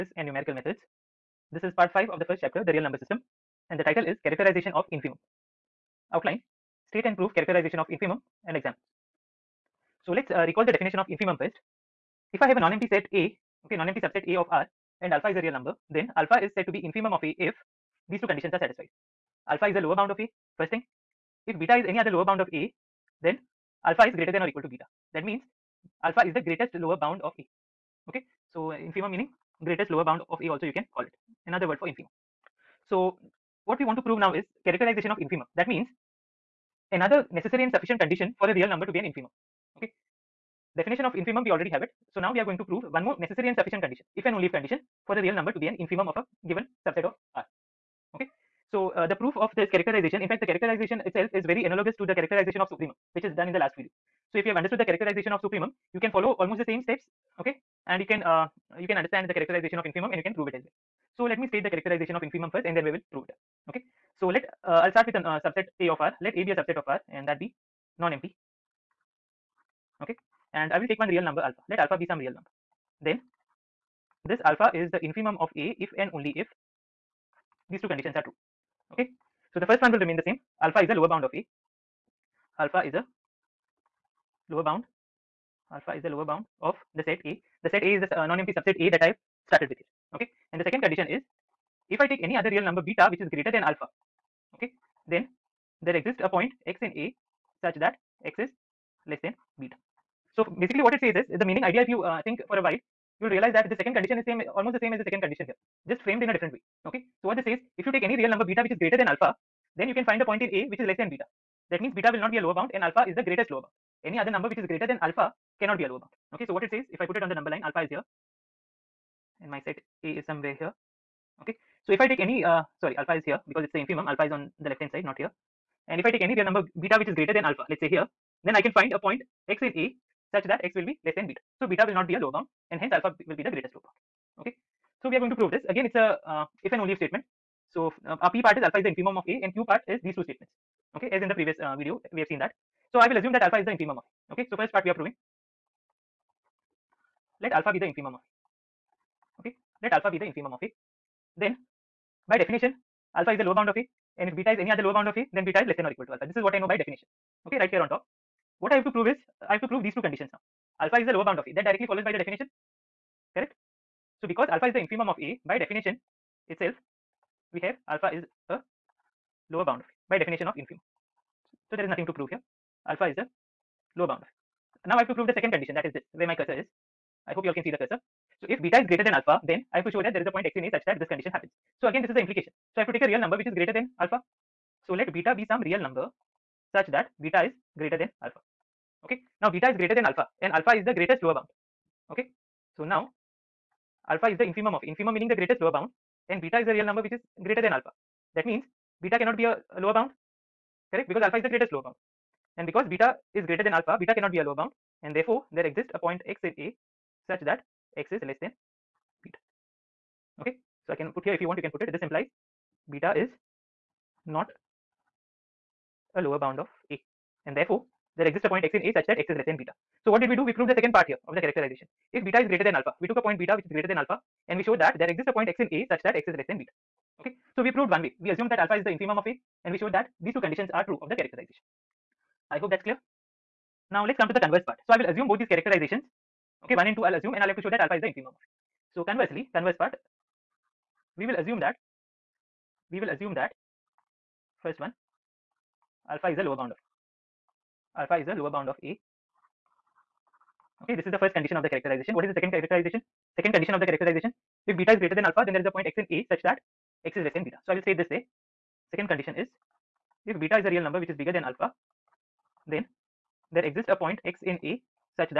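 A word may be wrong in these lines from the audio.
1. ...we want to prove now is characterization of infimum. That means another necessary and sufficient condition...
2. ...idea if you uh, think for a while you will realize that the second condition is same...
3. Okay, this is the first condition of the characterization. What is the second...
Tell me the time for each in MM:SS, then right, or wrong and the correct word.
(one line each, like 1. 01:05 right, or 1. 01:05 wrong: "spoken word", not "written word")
1. 00:33 right
2. 01:41 right
3. 04:10 right.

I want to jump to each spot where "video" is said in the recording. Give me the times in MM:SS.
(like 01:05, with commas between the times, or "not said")
00:53, 02:21.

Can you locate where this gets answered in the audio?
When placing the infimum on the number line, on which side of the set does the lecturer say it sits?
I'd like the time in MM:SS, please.
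02:04.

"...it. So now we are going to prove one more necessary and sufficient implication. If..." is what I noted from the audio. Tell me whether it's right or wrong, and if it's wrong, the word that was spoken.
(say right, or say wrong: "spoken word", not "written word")
wrong: "condition", not "implication".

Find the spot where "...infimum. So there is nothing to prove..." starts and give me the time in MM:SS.
02:50.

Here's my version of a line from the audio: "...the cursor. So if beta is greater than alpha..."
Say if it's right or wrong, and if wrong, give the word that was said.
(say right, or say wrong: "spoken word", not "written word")
right.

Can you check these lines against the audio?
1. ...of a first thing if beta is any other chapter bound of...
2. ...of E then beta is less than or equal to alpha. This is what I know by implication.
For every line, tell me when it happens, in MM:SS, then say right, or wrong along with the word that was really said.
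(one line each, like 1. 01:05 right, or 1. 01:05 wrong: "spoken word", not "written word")
1. 00:20 wrong: "lower", not "chapter"
2. 02:35 wrong: "definition", not "implication".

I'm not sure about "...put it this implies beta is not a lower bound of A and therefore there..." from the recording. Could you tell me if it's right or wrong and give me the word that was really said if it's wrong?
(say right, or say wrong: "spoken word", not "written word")
right.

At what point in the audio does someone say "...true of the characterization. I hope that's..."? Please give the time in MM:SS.
03:50.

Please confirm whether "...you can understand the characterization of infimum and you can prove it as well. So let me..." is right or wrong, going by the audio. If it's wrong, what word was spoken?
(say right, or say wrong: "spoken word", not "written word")
right.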